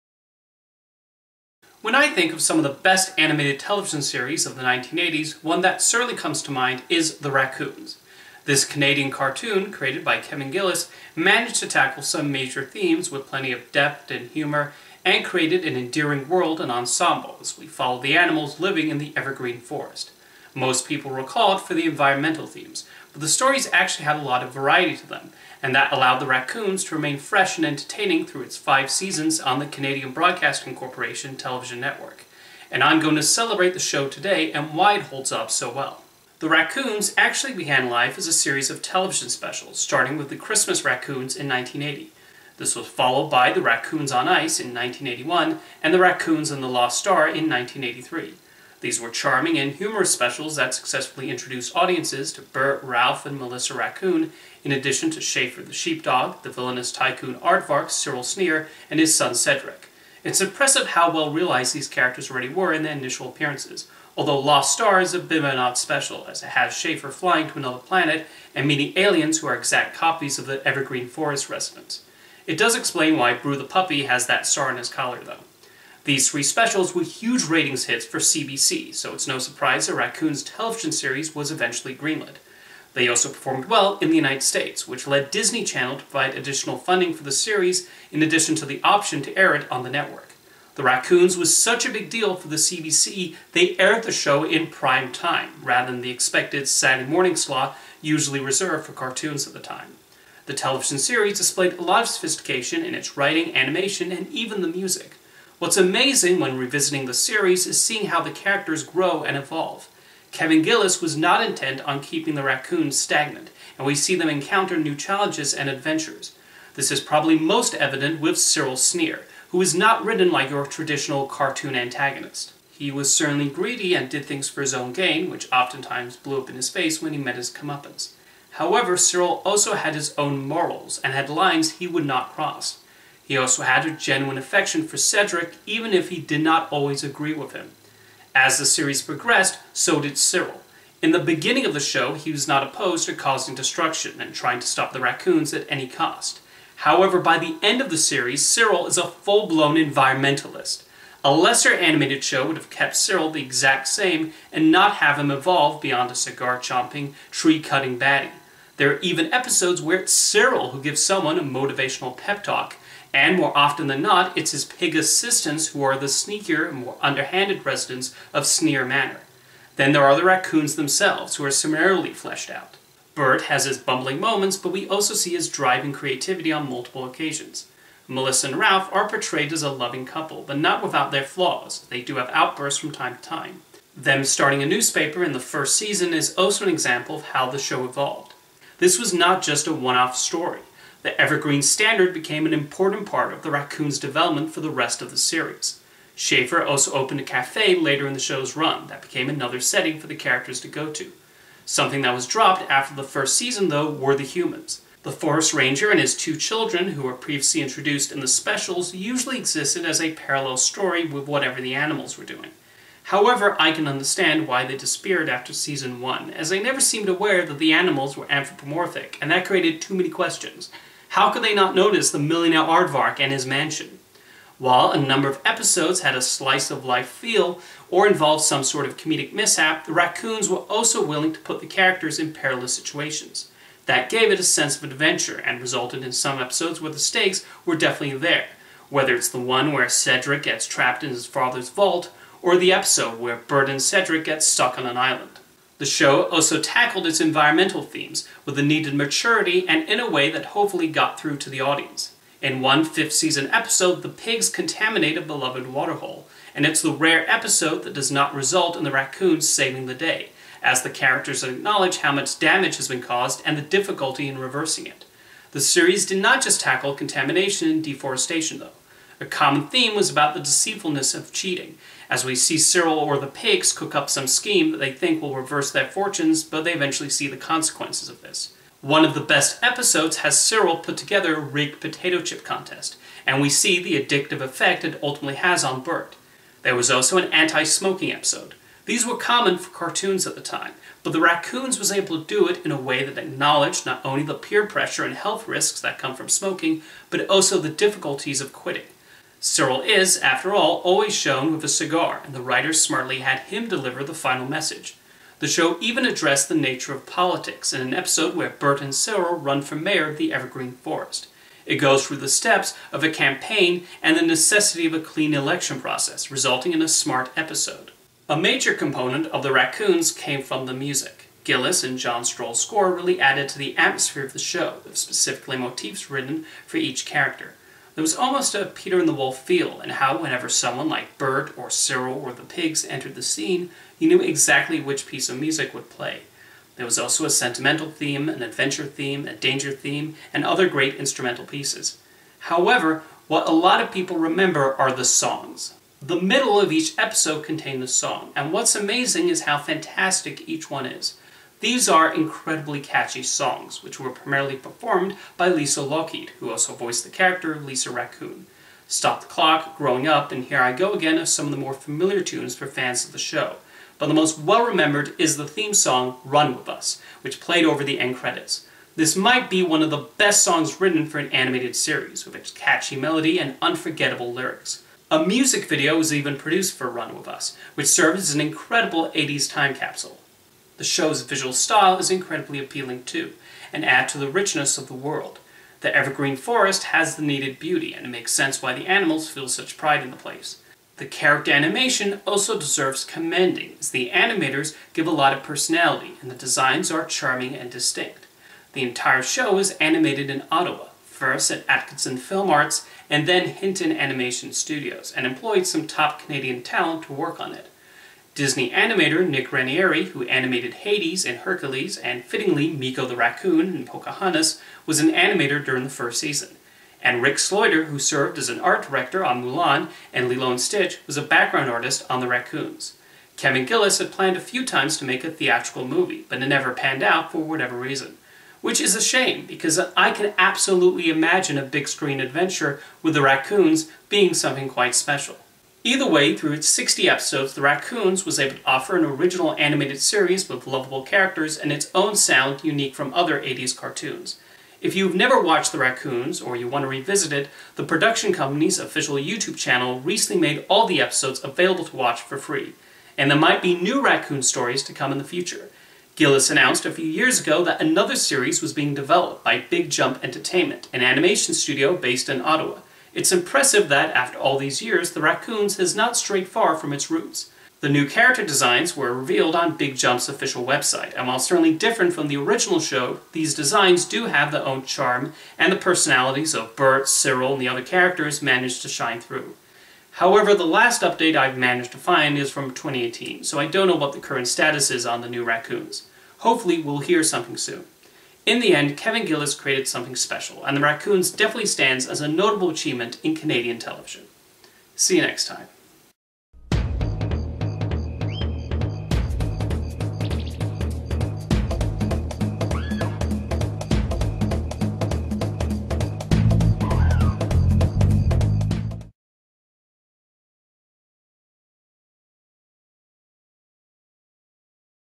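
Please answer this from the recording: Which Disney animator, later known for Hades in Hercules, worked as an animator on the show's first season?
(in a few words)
Nick Ranieri.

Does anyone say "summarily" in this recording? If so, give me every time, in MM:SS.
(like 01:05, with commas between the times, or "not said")
02:51.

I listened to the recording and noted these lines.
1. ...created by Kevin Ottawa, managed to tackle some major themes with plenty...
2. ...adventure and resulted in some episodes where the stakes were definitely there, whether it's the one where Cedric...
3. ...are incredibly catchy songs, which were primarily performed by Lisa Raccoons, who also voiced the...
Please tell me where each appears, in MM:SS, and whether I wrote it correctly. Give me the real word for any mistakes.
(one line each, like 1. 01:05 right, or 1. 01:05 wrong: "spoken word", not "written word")
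1. 00:09 wrong: "Gillis", not "Ottawa"
2. 03:54 right
3. 05:51 wrong: "Lougheed", not "Raccoons".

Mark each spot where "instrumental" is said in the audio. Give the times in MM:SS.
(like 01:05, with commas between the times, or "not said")
05:40.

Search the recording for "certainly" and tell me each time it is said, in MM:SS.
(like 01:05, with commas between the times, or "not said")
00:05, 02:03, 07:51.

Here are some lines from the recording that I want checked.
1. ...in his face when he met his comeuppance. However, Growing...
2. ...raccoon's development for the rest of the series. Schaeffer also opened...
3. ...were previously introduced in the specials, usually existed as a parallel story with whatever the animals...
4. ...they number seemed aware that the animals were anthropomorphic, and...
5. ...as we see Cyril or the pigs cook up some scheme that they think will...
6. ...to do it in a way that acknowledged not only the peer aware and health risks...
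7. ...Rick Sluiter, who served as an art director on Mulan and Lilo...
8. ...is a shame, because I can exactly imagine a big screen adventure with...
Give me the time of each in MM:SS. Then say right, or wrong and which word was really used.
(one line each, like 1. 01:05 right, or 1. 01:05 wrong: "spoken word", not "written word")
1. 02:06 wrong: "Cyril", not "Growing"
2. 03:13 right
3. 03:27 right
4. 03:36 wrong: "never", not "number"
5. 04:32 right
6. 04:52 wrong: "pressure", not "aware"
7. 06:57 right
8. 07:08 wrong: "absolutely", not "exactly".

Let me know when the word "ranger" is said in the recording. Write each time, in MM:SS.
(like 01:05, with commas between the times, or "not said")
03:25.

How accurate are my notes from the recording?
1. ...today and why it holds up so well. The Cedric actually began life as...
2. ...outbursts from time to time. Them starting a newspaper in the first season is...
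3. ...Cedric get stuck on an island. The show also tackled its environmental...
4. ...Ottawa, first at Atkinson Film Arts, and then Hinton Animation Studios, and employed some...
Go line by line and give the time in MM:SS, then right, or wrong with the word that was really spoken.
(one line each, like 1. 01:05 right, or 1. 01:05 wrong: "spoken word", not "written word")
1. 00:34 wrong: "Raccoons", not "Cedric"
2. 03:02 right
3. 04:03 right
4. 06:40 right.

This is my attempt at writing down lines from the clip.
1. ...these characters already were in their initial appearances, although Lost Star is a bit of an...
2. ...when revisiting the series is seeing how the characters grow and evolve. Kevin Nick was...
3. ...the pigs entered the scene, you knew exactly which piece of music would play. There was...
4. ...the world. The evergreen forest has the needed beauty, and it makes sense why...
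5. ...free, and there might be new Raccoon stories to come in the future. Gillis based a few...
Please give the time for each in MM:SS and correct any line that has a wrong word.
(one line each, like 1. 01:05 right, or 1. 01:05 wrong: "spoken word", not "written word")
1. 01:01 right
2. 01:46 wrong: "Gillis", not "Nick"
3. 05:32 right
4. 06:24 right
5. 07:32 wrong: "announced", not "based".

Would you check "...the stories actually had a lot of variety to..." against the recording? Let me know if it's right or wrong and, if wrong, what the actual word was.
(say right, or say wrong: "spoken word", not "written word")
right.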